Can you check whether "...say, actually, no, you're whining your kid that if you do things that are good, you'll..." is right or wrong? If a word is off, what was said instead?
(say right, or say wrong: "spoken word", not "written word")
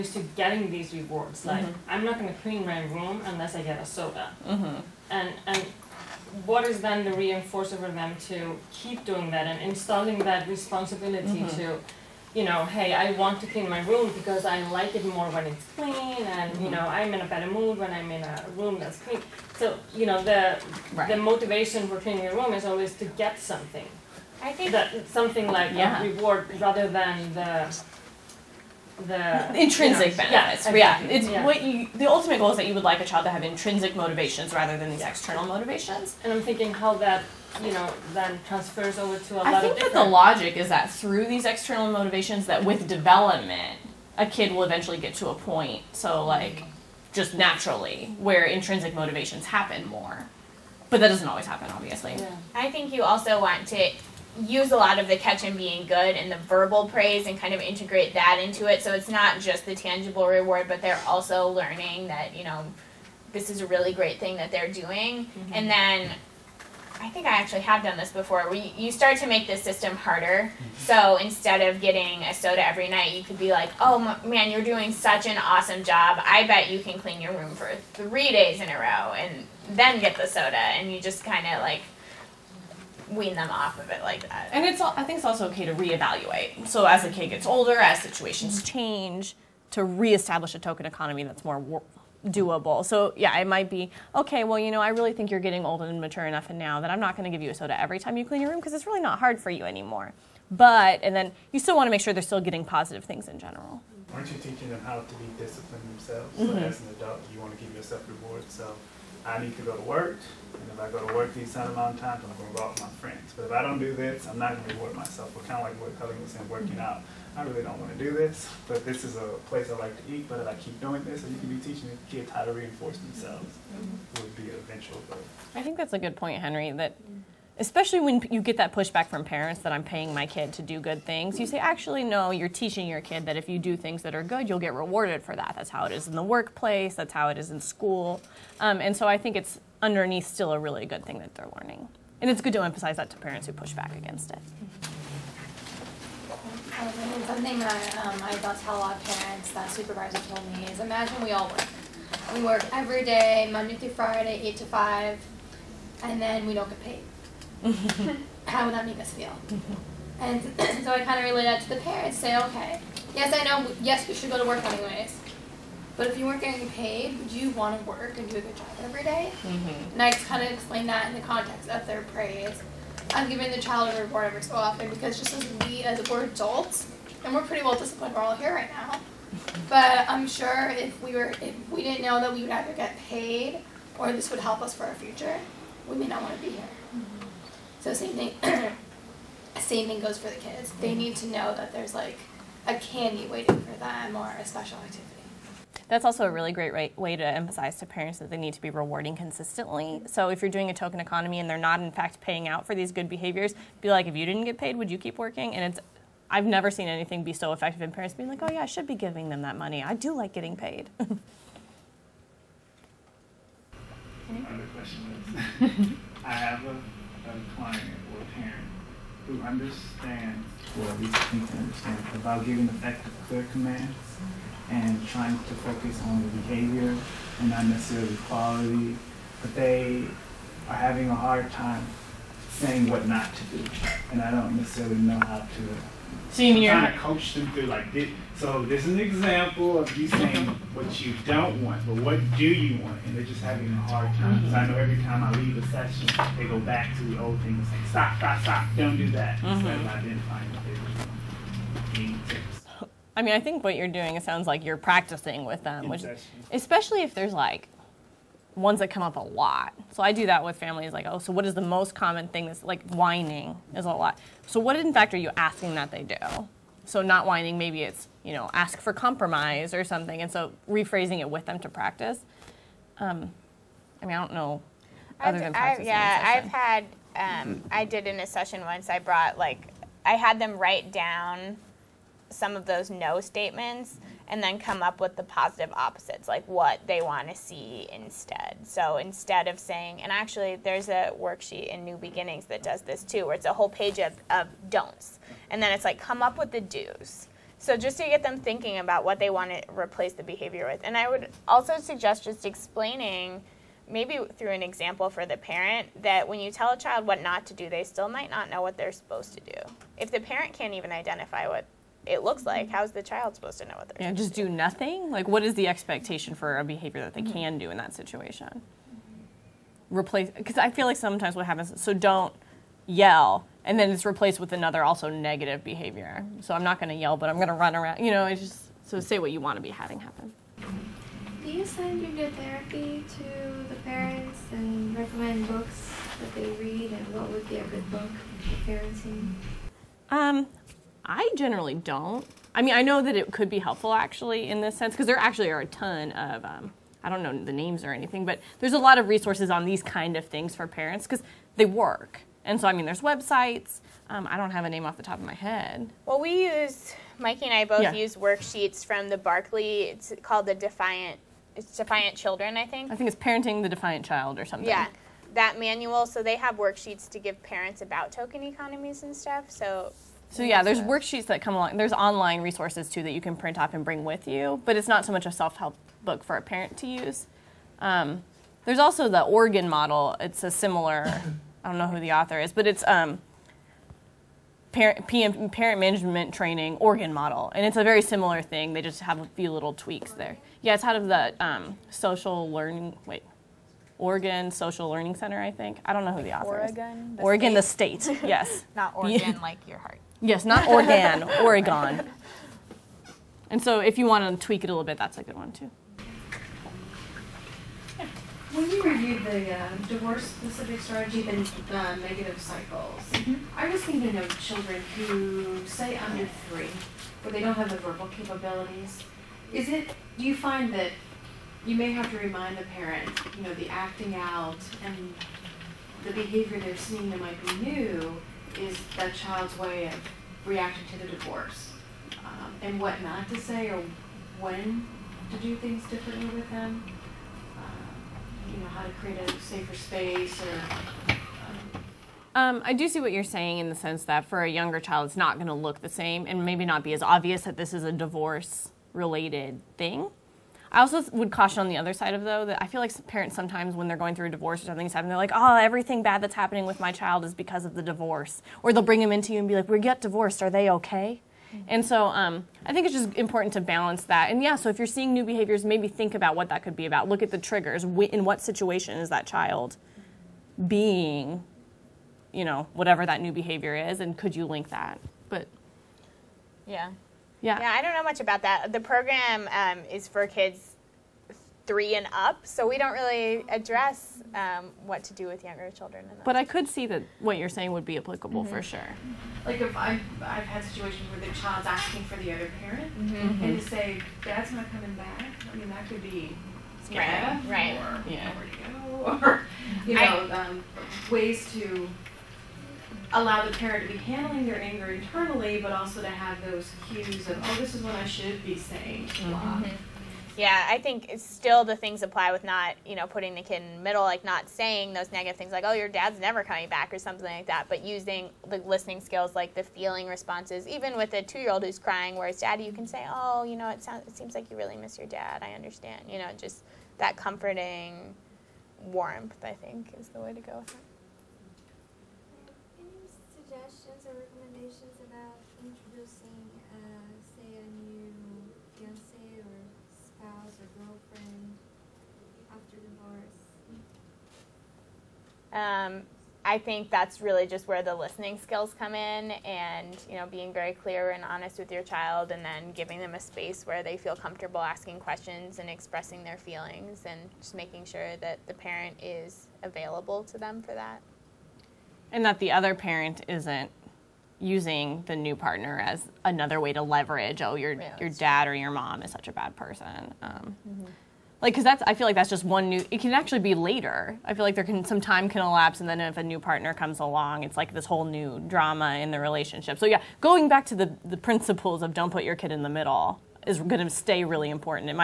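wrong: "teaching", not "whining".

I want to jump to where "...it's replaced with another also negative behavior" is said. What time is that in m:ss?
5:23.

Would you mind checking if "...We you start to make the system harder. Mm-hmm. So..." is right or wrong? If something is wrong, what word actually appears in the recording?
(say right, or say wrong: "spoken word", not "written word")
right.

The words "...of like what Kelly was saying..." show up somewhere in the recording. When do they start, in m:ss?
1:55.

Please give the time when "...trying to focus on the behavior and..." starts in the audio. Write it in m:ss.
3:45.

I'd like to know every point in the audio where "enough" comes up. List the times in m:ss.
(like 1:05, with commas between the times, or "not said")
1:36.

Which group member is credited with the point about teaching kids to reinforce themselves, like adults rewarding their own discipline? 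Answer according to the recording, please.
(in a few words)
Henry.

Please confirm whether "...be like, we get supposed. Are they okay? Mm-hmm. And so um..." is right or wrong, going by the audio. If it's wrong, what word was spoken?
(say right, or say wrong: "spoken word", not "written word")
wrong: "divorced", not "supposed".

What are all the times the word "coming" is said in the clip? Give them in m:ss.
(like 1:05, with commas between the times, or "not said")
8:14, 8:36.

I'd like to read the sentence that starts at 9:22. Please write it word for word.
And that the other parent isn't using the new partner as another way to leverage oh your yeah, your dad true.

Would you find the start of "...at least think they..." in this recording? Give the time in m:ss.
3:40.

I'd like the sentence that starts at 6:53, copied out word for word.
I was thinking of children who, say, under three, where they don't have the verbal capabilities.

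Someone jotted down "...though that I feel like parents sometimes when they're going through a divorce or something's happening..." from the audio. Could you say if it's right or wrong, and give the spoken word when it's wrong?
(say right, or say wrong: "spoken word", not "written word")
right.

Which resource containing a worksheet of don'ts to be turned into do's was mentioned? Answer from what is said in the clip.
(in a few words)
New Beginnings.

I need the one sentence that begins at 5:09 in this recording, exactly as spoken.
If the parent can't even identify what it looks like.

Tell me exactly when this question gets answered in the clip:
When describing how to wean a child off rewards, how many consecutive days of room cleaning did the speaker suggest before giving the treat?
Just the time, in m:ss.
1:17.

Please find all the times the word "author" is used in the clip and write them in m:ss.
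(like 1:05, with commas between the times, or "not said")
6:22, 6:36.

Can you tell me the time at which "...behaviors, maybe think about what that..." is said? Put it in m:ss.
7:45.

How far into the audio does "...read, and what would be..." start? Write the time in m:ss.
5:36.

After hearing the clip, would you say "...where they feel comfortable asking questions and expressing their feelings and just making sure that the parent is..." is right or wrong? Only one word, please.
right.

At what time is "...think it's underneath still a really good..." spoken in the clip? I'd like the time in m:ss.
2:19.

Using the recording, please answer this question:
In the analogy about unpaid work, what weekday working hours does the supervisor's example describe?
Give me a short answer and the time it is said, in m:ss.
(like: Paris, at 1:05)
8 to 5, at 2:34.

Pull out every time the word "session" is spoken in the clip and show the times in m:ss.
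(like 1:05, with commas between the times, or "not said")
4:05, 4:38.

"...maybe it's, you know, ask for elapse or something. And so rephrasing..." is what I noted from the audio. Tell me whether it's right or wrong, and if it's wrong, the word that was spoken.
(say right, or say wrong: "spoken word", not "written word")
wrong: "compromise", not "elapse".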